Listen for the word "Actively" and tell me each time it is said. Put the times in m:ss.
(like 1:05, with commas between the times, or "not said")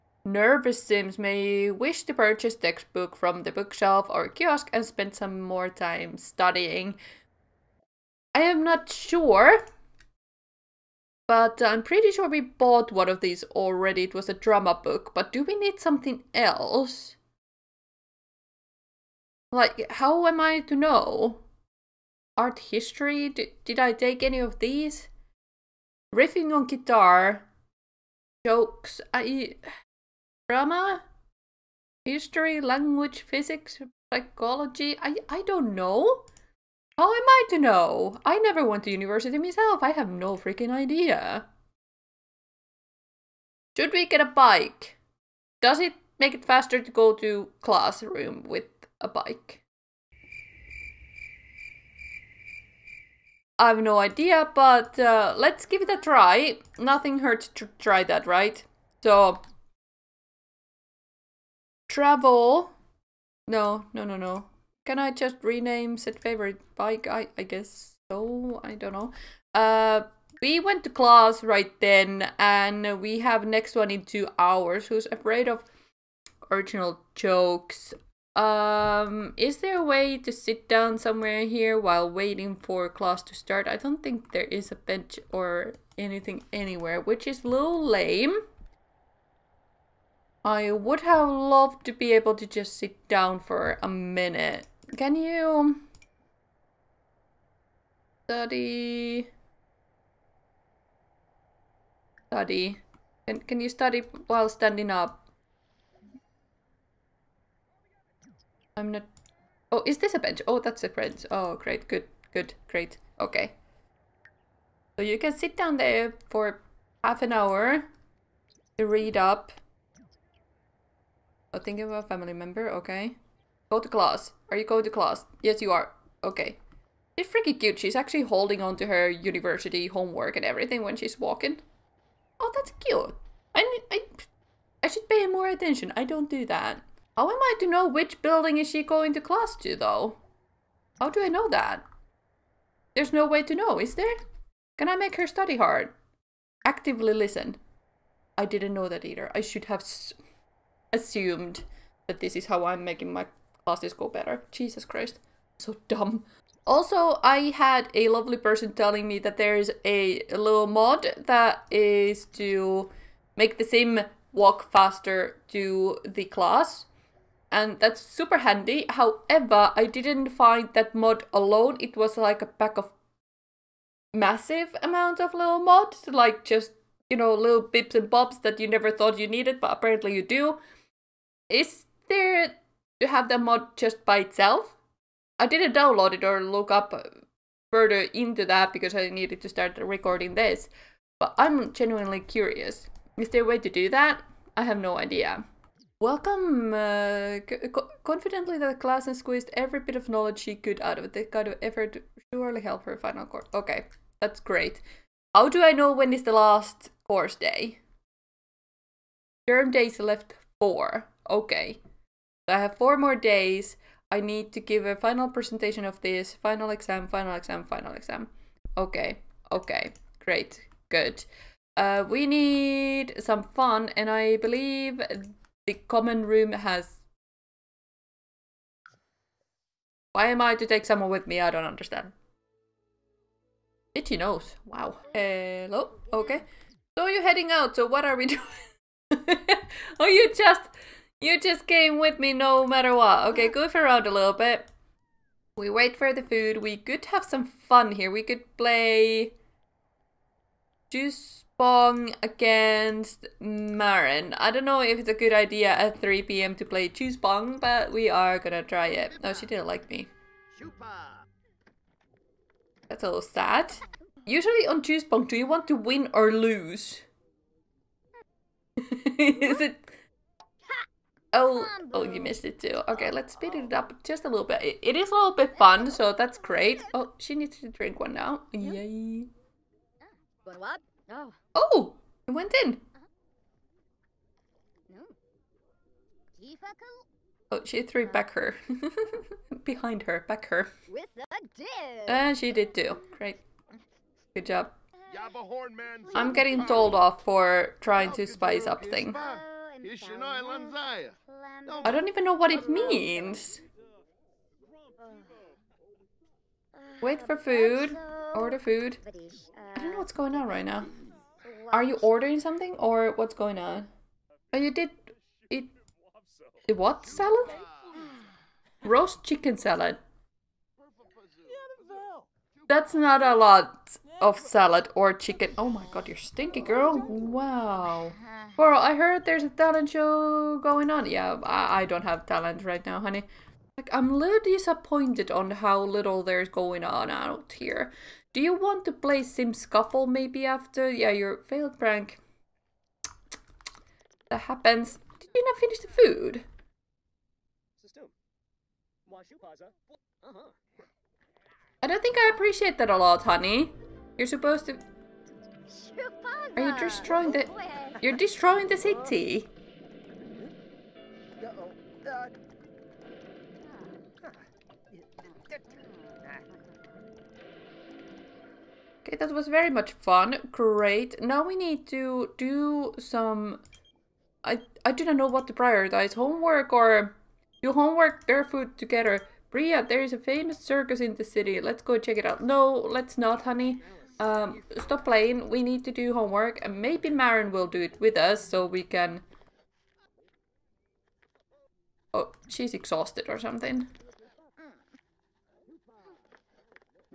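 2:26.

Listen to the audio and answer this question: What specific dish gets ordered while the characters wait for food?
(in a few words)
Roast chicken salad.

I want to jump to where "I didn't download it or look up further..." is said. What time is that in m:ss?
3:05.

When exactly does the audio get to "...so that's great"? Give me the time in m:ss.
4:35.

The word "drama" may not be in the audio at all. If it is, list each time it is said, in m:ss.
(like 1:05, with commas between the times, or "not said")
0:14, 0:30.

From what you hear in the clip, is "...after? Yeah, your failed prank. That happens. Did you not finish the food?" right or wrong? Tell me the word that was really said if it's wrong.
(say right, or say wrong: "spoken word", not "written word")
right.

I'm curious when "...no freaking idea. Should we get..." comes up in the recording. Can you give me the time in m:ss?
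0:40.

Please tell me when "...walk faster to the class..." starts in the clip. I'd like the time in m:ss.
2:44.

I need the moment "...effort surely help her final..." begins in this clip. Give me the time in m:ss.
3:21.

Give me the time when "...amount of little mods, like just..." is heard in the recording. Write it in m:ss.
2:54.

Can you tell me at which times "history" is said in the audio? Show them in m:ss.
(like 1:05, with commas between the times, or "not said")
0:22, 0:32.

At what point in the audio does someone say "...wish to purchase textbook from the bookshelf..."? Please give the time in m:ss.
0:01.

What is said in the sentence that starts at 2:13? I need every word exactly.
I, I, I should pay more attention.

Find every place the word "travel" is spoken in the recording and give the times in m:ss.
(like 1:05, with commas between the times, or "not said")
1:01.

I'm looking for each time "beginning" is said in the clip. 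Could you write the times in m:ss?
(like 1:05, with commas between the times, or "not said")
not said.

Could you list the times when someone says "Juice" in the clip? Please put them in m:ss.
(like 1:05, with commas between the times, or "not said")
4:10, 4:16, 4:24.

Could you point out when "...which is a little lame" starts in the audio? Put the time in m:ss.
1:26.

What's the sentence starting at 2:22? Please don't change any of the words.
There's no way to know, is there?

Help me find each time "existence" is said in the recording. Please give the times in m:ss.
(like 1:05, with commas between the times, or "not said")
not said.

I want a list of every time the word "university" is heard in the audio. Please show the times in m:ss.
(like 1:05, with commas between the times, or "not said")
0:38, 2:09.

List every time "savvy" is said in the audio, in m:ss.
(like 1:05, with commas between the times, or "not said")
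not said.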